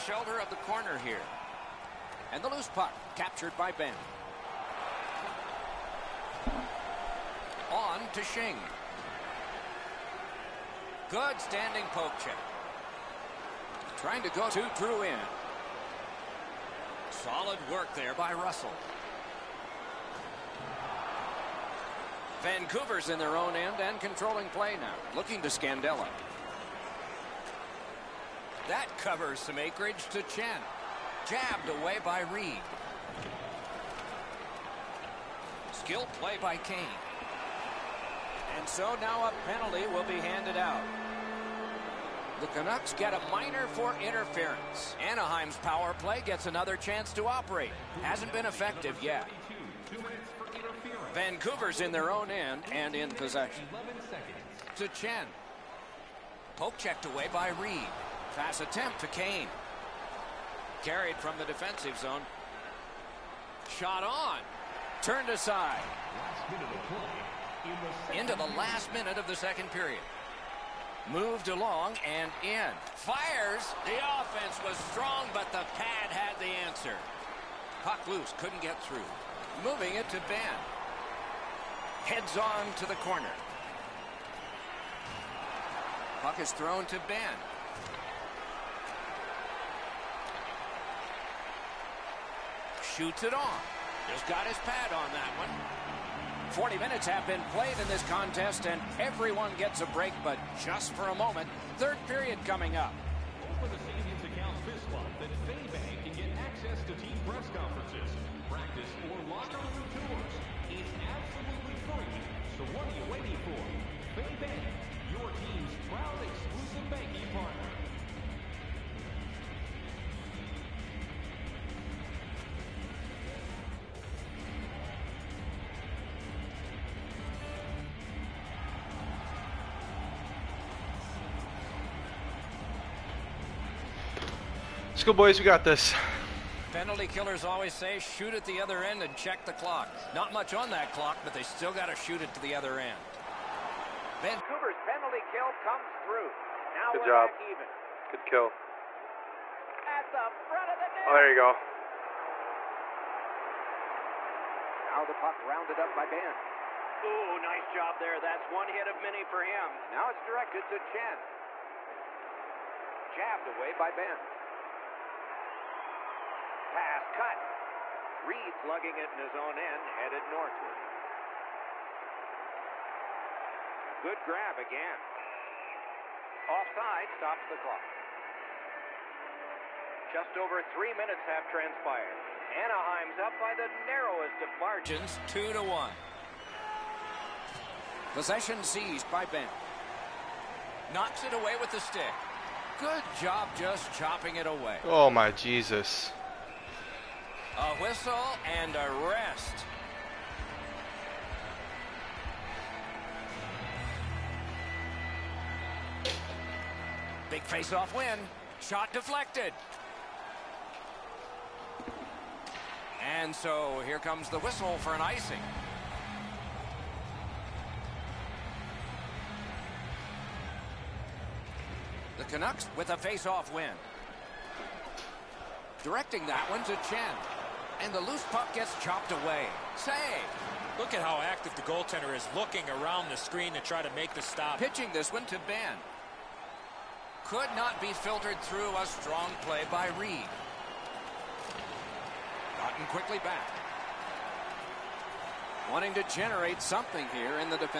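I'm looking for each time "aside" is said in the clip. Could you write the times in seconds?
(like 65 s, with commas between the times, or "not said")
65 s.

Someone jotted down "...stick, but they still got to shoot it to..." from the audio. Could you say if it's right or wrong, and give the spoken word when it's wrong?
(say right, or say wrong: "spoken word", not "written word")
wrong: "clock", not "stick".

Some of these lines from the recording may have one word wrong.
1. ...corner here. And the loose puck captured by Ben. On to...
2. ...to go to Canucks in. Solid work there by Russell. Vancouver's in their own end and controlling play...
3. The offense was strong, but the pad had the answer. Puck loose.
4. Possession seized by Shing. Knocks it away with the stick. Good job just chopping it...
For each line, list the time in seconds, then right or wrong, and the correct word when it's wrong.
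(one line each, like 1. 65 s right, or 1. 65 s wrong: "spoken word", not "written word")
1. 0 s right
2. 14 s wrong: "Drew", not "Canucks"
3. 73 s right
4. 188 s wrong: "Ben", not "Shing".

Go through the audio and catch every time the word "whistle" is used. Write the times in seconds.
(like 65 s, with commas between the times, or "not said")
197 s, 214 s.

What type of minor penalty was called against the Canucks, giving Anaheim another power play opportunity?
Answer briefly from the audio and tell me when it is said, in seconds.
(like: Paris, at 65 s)
Interference, at 44 s.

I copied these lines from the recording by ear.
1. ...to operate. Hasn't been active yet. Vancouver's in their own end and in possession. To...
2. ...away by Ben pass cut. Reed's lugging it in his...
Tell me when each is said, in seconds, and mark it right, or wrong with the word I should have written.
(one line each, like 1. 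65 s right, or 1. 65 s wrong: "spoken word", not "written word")
1. 47 s wrong: "effective", not "active"
2. 163 s right.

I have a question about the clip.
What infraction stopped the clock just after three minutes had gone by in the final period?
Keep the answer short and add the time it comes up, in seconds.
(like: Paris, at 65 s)
Offside, at 176 s.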